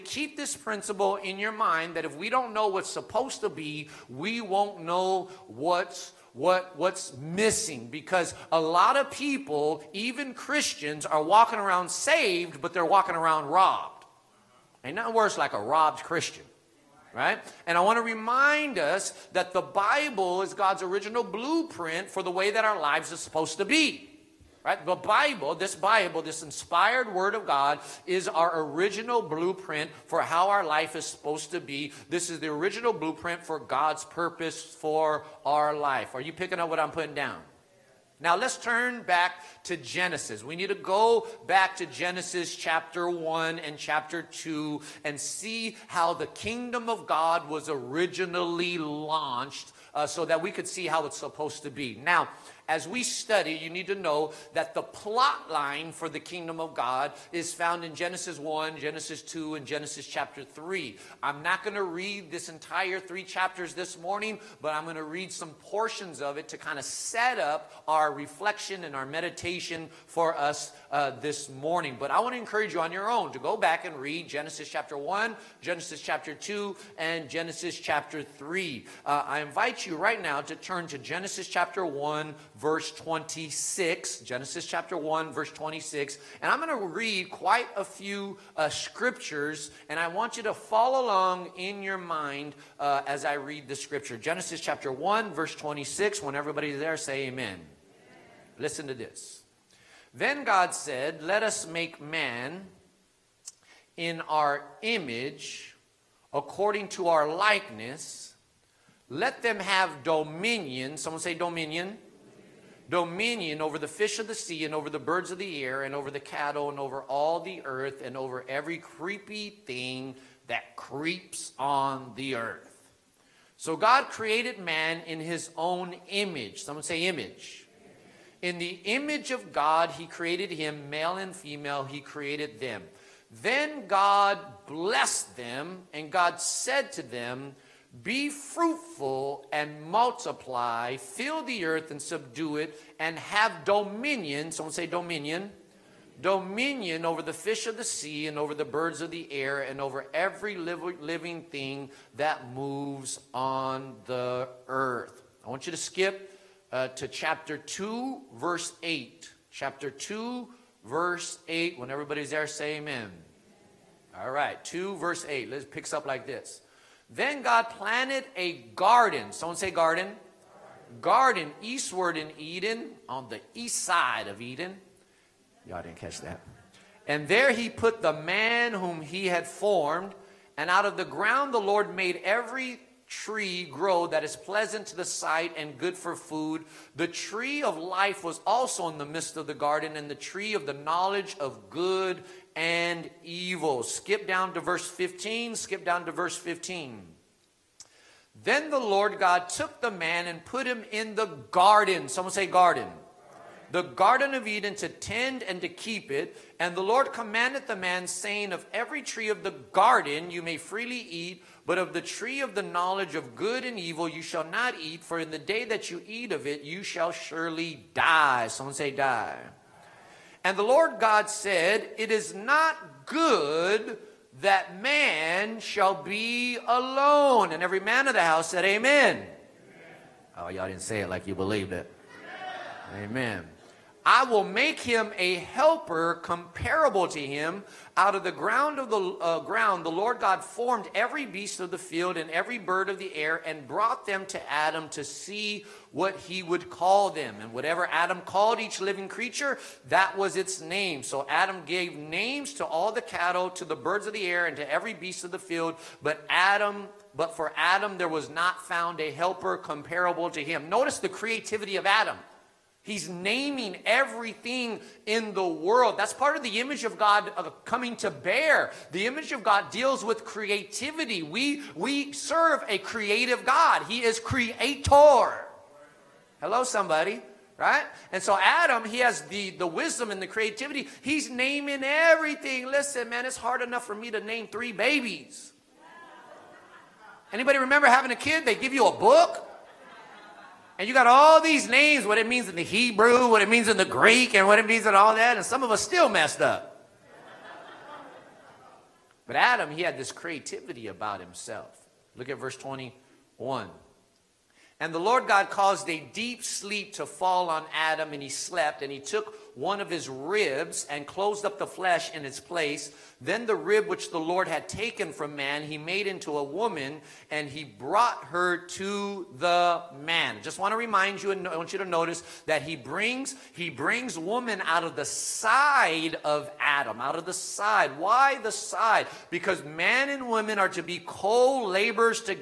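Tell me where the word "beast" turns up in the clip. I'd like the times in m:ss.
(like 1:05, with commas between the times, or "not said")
4:01, 4:14.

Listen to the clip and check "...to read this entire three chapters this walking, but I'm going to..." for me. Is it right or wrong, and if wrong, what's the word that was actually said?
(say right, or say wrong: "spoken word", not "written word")
wrong: "morning", not "walking".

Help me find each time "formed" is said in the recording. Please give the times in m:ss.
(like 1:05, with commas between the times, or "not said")
2:59, 4:00.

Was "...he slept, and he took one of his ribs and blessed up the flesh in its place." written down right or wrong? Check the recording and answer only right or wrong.
wrong.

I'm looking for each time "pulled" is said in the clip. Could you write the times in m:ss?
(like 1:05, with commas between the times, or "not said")
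not said.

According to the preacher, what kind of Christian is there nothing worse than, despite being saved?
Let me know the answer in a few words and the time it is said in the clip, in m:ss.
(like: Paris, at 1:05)
A robbed Christian, at 0:15.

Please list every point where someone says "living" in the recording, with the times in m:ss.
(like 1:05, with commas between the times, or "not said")
2:30, 4:08.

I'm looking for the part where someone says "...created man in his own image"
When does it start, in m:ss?
2:04.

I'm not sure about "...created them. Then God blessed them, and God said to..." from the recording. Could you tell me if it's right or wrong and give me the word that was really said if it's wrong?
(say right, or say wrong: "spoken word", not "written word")
right.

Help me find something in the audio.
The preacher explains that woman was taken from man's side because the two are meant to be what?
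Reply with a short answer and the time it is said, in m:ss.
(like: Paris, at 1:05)
Co-laborers, at 5:30.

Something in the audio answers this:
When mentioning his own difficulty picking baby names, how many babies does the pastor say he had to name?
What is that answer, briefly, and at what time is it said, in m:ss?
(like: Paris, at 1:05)
3, at 4:44.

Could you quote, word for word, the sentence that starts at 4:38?
And so Adam, he has the, the wisdom and the creativity.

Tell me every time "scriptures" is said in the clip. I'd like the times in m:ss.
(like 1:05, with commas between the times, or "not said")
1:28, 1:33.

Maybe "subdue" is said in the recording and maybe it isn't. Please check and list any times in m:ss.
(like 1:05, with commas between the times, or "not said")
2:22.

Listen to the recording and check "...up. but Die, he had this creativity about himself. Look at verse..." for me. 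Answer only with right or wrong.
wrong.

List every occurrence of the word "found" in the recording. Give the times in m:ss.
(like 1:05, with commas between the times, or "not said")
0:57, 4:18.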